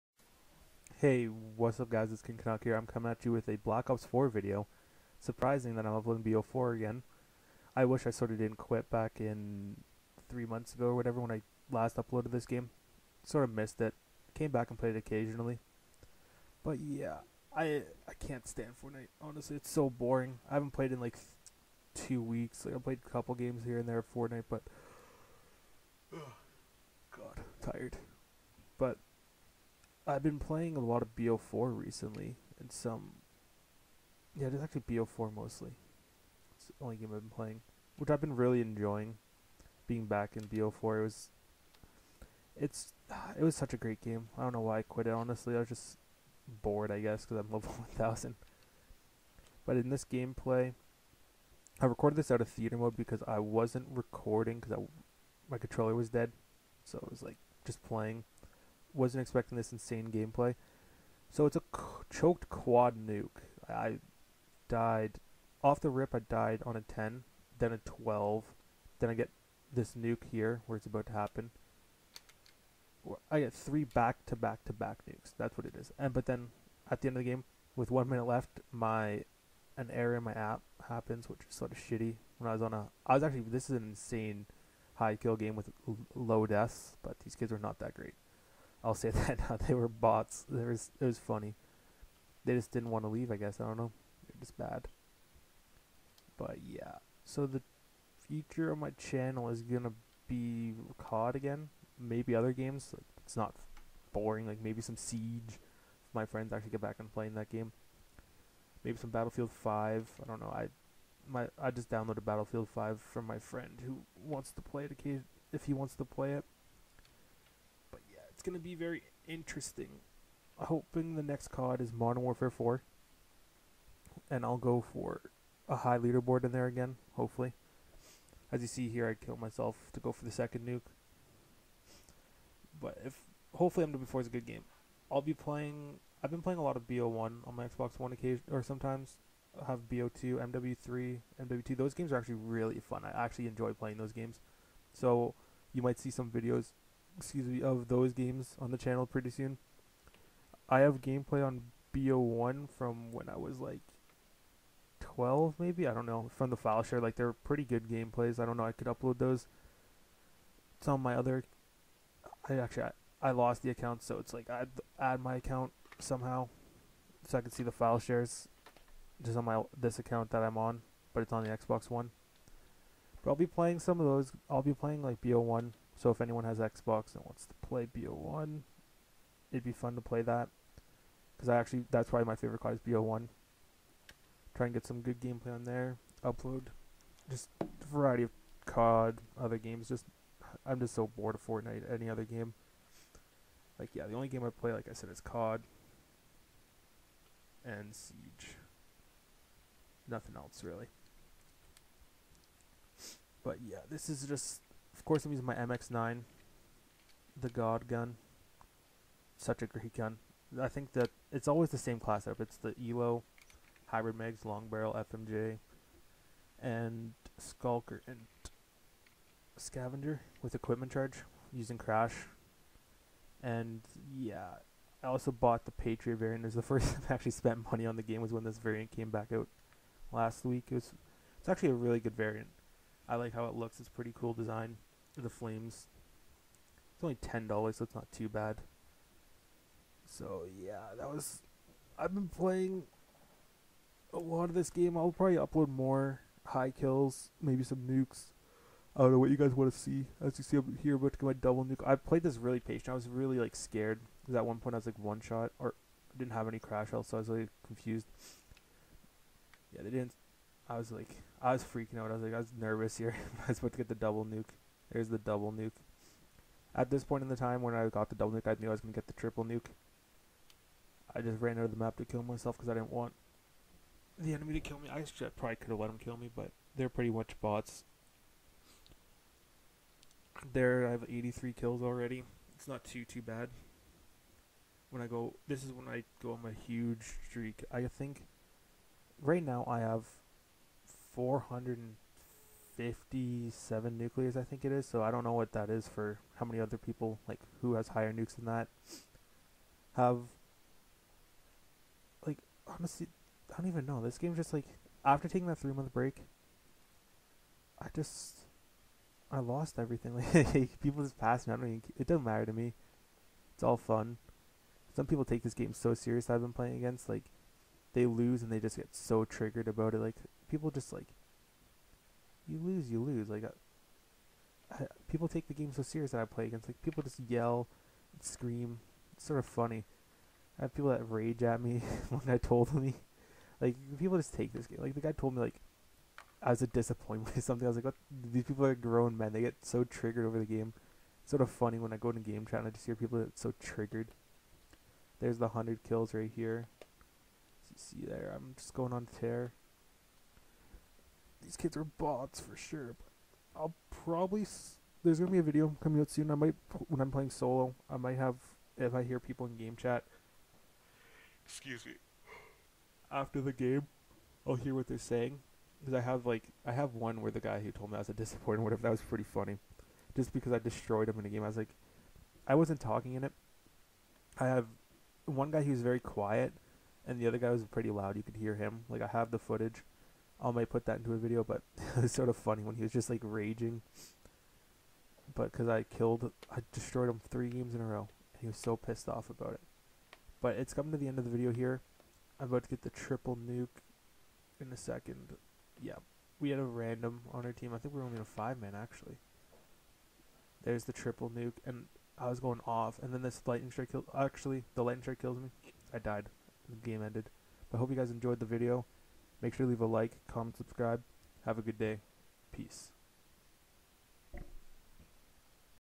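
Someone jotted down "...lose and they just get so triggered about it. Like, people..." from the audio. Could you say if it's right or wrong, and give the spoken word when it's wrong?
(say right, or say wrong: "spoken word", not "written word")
right.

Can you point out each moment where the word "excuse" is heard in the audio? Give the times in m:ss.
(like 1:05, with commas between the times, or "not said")
2:27, 6:01.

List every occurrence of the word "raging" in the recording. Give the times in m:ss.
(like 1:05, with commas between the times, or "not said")
6:23.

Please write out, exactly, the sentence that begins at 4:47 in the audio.
I think right now I have 400 57 nucleus, I think it is.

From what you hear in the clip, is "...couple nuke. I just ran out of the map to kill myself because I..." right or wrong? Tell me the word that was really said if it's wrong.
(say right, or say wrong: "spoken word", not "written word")
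wrong: "triple", not "couple".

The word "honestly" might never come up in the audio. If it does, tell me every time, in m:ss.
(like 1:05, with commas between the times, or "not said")
0:19, 0:45, 5:02.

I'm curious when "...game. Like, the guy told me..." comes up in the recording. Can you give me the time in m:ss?
5:34.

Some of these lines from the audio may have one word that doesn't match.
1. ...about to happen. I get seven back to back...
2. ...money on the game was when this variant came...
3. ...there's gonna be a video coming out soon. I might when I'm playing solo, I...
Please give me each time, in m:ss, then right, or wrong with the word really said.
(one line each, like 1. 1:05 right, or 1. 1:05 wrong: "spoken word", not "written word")
1. 1:10 wrong: "three", not "seven"
2. 3:47 right
3. 5:55 right.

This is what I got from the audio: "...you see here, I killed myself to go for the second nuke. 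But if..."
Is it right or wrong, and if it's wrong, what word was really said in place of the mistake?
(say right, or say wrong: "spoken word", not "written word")
right.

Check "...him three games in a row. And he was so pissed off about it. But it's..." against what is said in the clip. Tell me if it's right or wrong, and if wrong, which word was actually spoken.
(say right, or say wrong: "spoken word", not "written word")
right.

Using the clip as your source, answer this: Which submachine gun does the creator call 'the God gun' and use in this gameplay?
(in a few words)
MX-9.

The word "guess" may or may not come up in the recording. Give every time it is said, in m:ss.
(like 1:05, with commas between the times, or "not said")
0:46, 1:33.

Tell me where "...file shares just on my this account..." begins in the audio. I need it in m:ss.
2:47.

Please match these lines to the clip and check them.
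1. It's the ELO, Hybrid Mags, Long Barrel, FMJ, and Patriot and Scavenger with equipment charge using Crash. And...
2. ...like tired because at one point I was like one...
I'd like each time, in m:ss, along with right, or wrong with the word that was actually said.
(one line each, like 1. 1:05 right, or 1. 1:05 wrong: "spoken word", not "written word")
1. 3:32 wrong: "Skulker", not "Patriot"
2. 4:13 wrong: "scared", not "tired".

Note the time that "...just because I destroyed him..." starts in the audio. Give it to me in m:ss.
6:10.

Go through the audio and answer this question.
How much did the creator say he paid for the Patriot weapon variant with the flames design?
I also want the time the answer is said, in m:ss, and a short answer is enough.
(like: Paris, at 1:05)
$10, at 3:57.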